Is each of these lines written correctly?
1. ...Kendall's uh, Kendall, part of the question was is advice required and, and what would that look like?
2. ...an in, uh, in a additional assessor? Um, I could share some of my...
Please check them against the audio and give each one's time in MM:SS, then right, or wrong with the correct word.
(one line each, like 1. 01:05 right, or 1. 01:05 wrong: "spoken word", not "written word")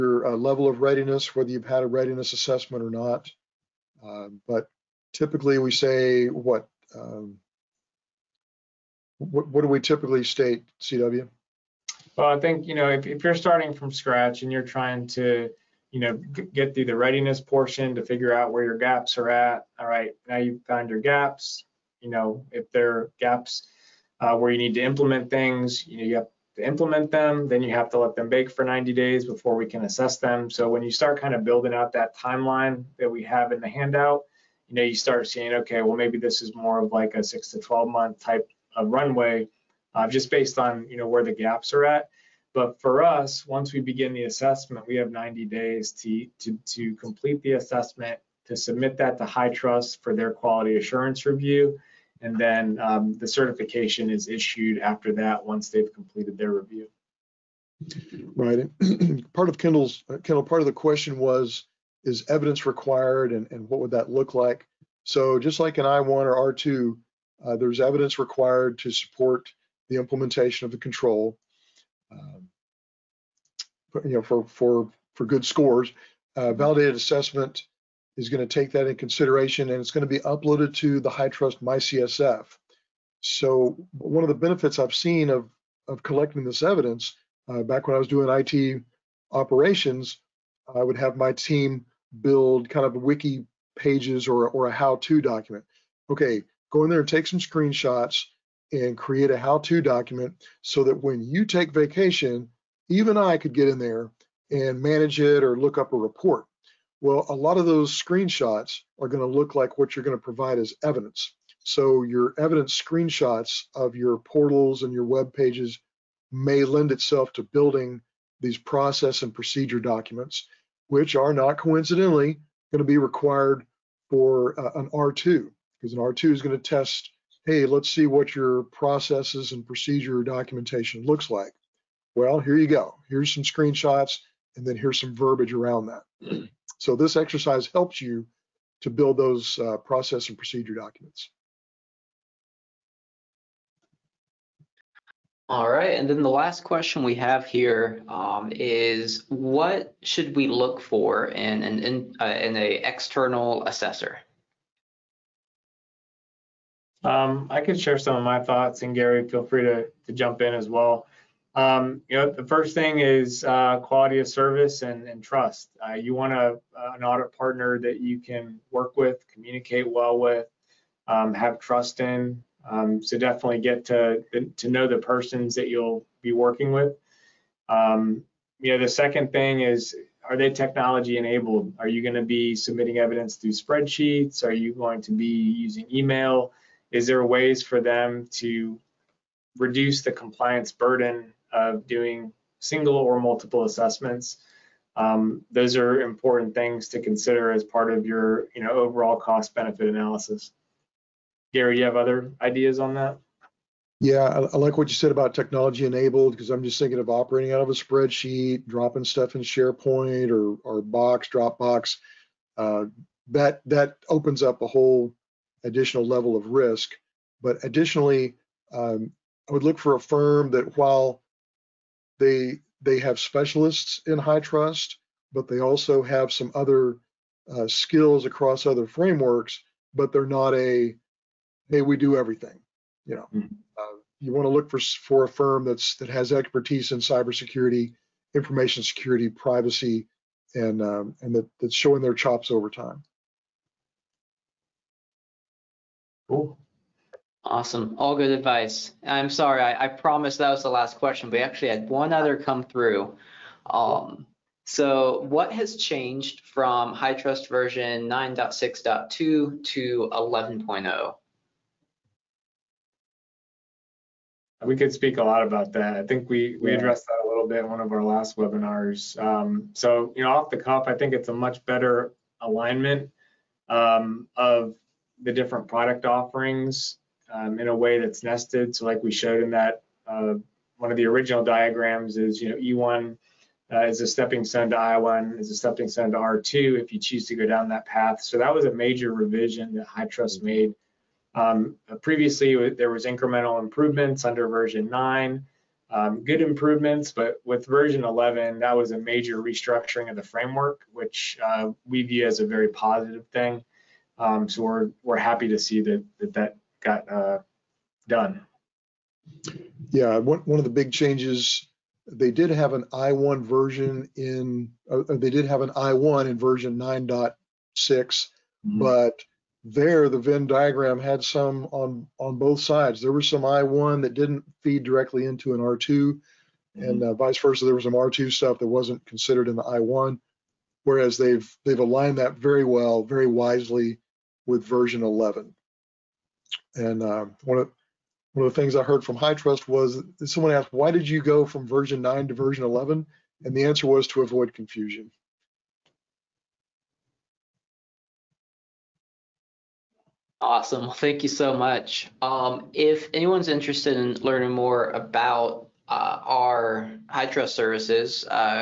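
1. 00:59 wrong: "evidence", not "advice"
2. 02:31 wrong: "external", not "additional".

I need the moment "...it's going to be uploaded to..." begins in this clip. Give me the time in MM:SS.
01:19.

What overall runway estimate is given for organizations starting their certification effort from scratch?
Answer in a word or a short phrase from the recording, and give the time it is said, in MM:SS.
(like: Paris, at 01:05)
6 to 12 months, at 00:37.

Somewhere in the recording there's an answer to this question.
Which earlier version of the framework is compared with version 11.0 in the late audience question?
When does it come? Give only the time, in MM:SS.
04:18.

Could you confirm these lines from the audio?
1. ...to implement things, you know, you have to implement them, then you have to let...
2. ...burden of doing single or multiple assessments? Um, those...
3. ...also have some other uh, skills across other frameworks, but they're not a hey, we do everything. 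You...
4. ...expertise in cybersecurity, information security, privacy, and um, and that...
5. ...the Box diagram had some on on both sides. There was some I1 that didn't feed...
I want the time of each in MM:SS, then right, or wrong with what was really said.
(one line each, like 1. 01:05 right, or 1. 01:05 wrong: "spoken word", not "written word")
1. 00:24 right
2. 03:10 right
3. 03:45 right
4. 03:56 right
5. 05:20 wrong: "Venn", not "Box".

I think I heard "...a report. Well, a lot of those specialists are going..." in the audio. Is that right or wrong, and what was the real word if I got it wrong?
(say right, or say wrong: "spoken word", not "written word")
wrong: "screenshots", not "specialists".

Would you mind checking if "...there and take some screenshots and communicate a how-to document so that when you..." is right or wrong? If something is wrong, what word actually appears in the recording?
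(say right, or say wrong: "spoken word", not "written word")
wrong: "create", not "communicate".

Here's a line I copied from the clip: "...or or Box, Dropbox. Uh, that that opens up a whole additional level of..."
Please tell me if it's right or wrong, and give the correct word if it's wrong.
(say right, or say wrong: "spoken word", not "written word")
right.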